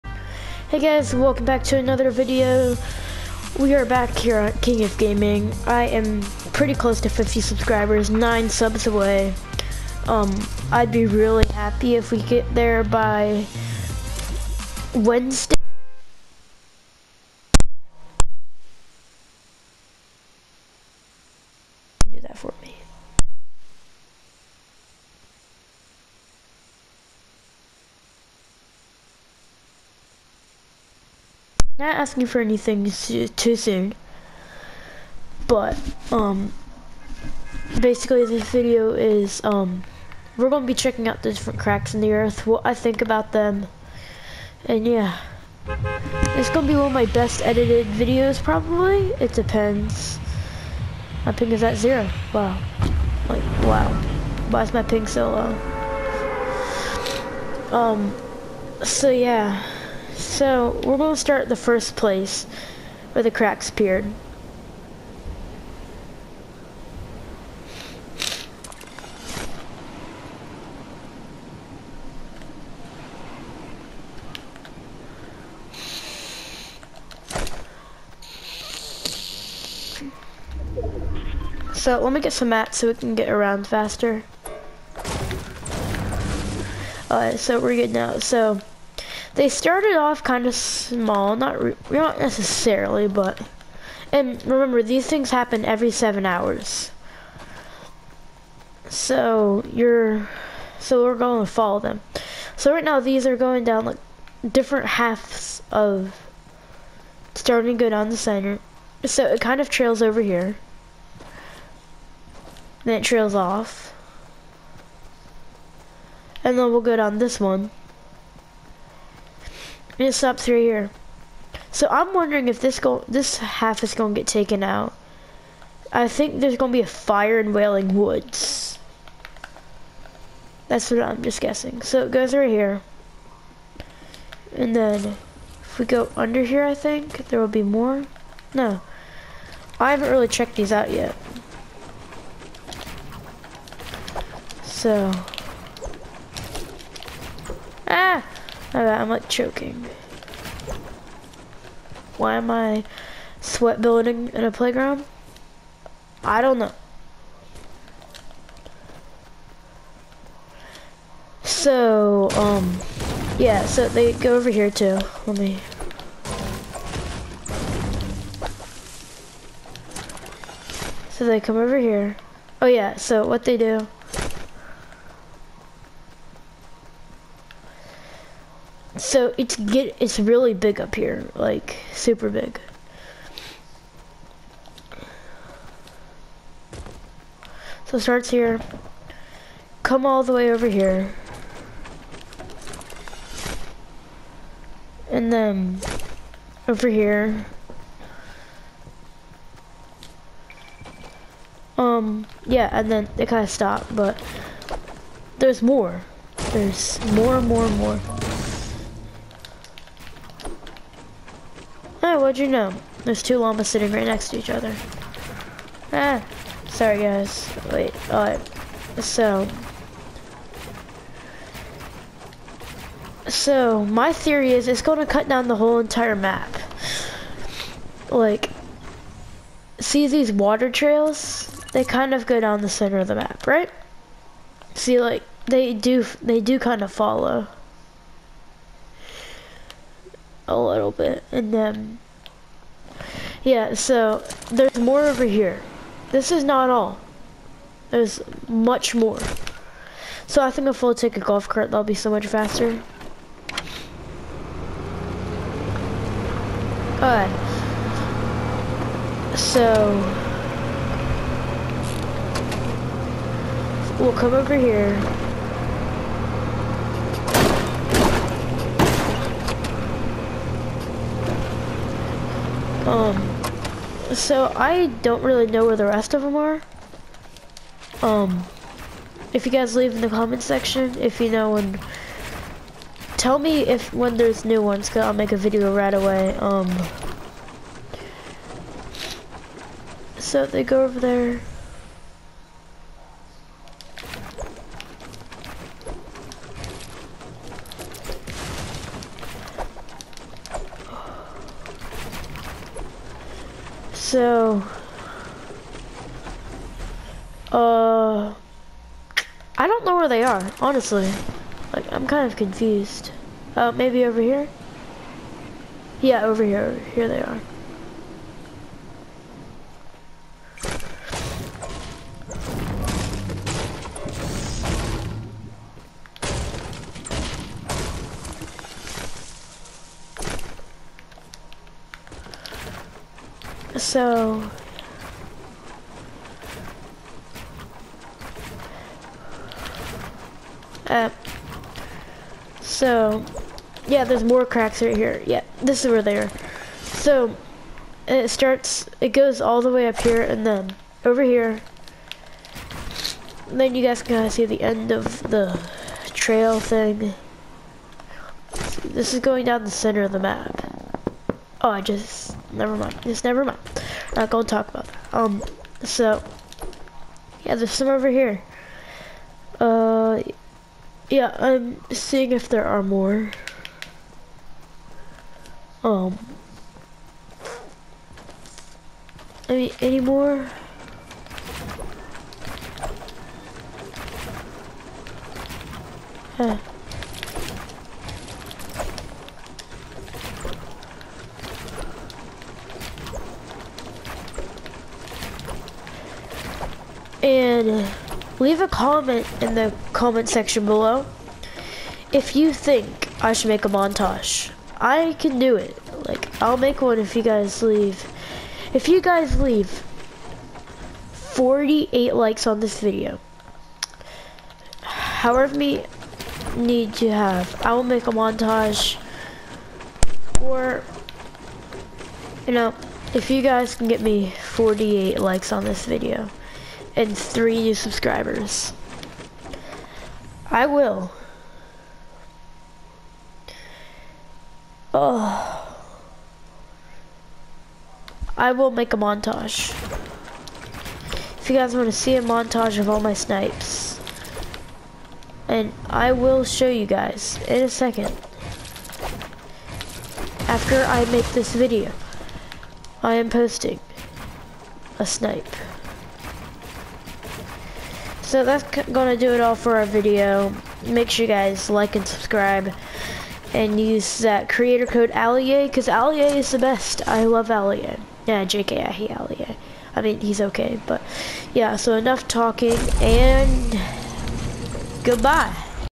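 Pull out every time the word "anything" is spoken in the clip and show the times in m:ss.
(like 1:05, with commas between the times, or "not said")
0:32.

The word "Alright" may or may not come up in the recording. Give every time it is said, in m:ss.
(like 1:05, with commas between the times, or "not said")
1:27, 4:17.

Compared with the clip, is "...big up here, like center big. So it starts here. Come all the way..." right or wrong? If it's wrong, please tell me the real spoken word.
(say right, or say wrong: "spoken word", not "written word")
wrong: "super", not "center".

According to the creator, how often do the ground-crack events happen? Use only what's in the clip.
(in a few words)
Every 7 hours.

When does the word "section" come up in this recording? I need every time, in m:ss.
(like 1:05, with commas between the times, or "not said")
4:40, 6:40.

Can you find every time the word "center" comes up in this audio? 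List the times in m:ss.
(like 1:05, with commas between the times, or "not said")
1:48, 3:52, 5:59.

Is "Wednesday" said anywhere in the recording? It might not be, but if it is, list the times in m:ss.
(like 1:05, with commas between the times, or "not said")
0:14.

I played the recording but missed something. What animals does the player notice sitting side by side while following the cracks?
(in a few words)
Llamas.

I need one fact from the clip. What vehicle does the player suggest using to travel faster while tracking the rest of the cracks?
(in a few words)
Golf cart.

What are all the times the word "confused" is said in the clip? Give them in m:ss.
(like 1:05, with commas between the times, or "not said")
5:12.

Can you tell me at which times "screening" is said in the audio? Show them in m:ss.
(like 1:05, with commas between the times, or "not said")
not said.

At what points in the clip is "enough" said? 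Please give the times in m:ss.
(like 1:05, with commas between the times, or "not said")
7:51.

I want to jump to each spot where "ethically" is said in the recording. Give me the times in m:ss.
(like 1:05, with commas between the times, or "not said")
not said.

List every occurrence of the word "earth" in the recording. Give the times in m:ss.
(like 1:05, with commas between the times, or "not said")
0:42.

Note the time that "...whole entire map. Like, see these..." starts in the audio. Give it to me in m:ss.
3:45.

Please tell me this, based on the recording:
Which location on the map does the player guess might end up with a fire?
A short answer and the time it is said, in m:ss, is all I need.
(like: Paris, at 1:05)
Wailing Woods, at 2:07.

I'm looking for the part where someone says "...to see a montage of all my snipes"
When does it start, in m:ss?
7:21.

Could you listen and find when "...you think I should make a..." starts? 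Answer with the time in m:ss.
6:42.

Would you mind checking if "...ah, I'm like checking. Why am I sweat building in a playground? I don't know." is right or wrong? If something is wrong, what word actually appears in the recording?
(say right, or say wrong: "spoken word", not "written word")
wrong: "choking", not "checking".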